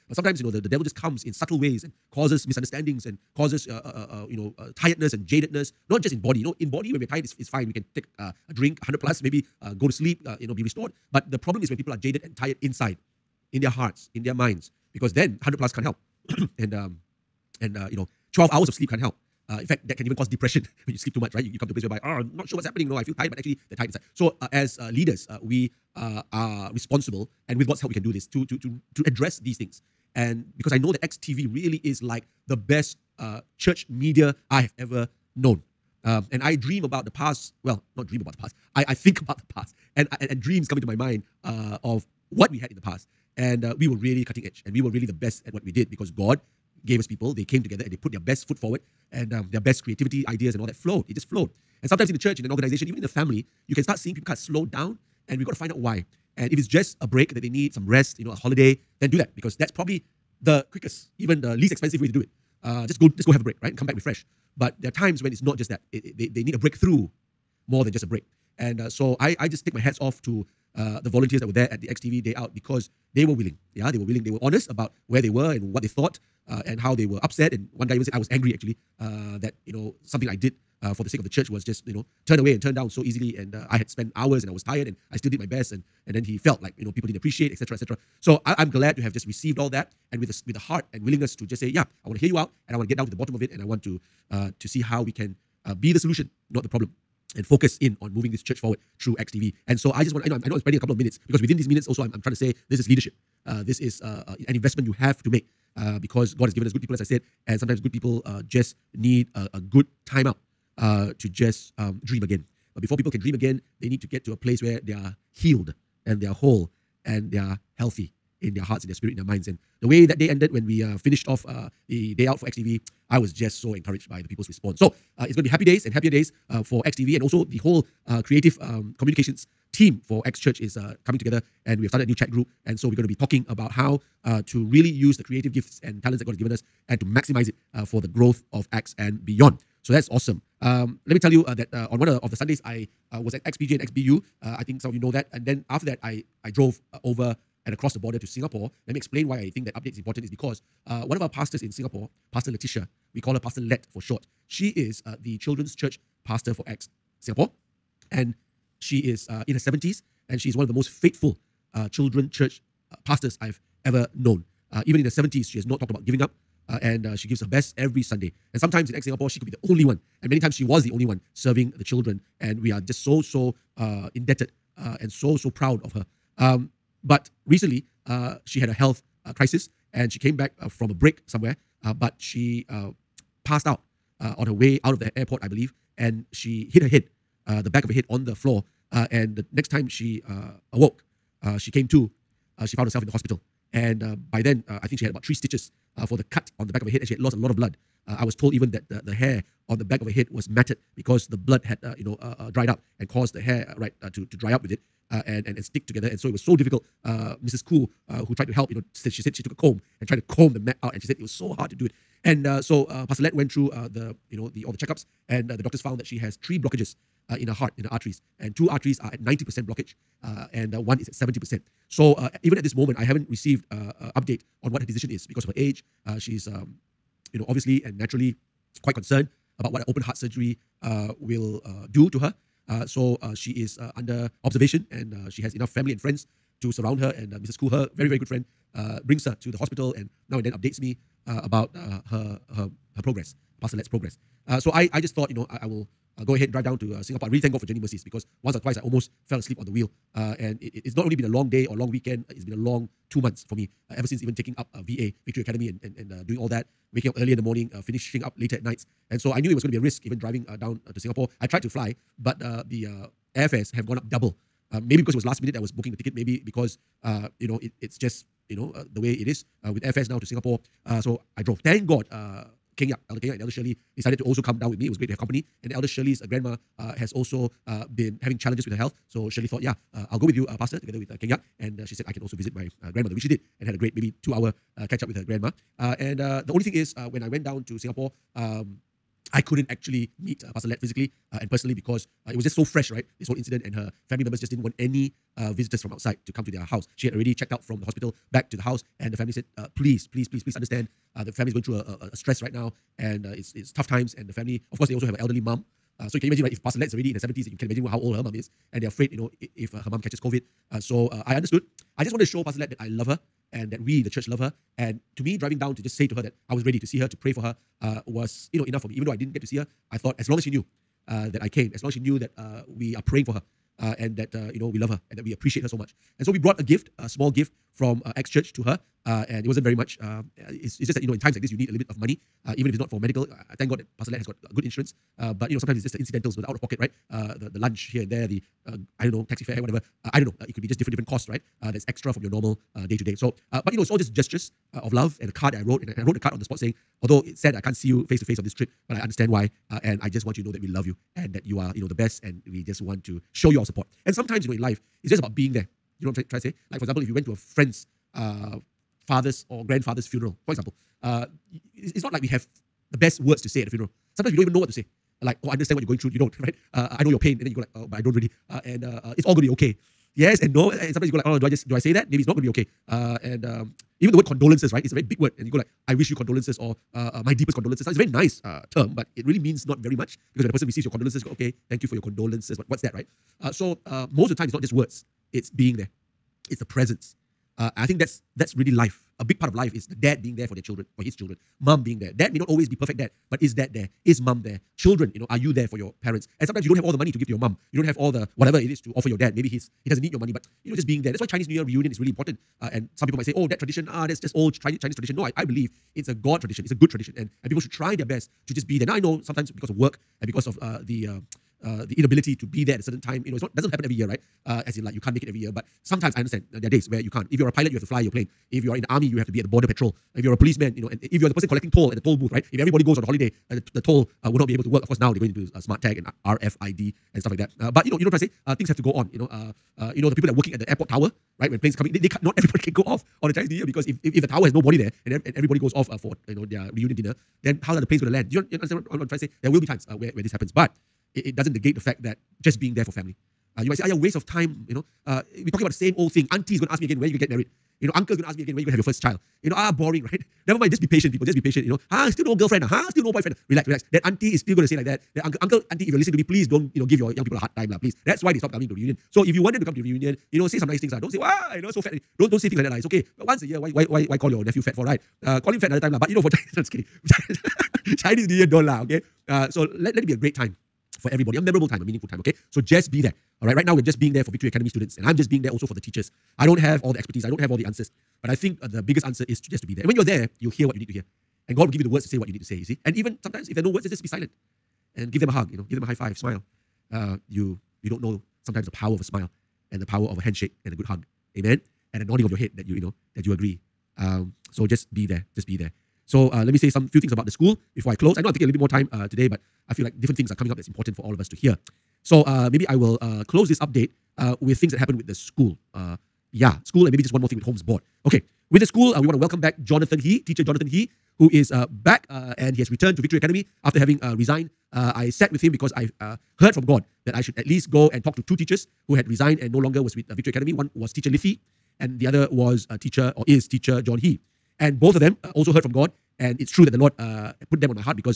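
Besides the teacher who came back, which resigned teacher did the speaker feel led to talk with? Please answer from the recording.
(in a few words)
Lithi.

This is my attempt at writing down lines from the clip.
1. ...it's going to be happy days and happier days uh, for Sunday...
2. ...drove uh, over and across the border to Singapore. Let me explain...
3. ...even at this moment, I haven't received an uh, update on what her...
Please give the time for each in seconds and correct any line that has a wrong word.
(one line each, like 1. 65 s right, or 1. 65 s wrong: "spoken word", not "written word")
1. 125 s wrong: "XTV", not "Sunday"
2. 146 s right
3. 222 s right.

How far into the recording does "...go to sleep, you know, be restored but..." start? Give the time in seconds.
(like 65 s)
9 s.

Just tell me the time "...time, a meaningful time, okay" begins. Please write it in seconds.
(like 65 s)
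471 s.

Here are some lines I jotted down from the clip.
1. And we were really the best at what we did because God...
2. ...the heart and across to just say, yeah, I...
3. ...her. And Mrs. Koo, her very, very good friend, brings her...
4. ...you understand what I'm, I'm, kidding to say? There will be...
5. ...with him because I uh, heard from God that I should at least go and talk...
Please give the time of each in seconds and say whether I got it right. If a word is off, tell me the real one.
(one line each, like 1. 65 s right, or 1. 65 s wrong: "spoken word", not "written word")
1. 44 s right
2. 90 s wrong: "willingness", not "across"
3. 236 s right
4. 438 s wrong: "trying", not "kidding"
5. 515 s right.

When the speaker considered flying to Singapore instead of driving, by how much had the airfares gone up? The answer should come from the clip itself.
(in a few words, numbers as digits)
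Double.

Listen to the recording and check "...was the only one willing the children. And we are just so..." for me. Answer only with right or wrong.
wrong.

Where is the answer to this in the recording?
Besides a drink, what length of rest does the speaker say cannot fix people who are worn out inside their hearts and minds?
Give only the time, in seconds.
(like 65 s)
18 s.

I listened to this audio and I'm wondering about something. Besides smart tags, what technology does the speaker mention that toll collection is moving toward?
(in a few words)
RFID.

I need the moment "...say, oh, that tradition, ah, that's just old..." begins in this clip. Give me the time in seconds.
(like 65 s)
403 s.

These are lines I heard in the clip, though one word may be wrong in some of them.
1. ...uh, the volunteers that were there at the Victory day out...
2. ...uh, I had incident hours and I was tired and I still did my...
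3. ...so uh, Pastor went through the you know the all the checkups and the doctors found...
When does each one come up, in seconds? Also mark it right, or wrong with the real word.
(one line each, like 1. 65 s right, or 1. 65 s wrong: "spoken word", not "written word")
1. 70 s wrong: "XTV", not "Victory"
2. 83 s wrong: "spent", not "incident"
3. 212 s right.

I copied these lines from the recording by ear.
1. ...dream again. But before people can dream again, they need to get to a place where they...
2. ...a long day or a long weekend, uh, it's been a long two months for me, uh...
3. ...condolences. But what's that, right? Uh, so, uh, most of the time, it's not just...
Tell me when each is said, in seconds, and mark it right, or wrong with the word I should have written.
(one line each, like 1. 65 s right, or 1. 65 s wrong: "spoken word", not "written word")
1. 112 s right
2. 251 s right
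3. 382 s right.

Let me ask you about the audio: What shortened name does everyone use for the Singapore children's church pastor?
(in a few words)
Letitia.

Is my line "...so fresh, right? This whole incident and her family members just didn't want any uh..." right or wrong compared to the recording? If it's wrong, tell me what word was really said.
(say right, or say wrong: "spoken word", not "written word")
right.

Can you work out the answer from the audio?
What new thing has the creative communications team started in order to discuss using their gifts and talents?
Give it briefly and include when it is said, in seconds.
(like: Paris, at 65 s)
A new chat group, at 132 s.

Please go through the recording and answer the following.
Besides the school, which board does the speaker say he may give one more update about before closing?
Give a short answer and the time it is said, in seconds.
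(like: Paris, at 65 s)
Holmes Board, at 507 s.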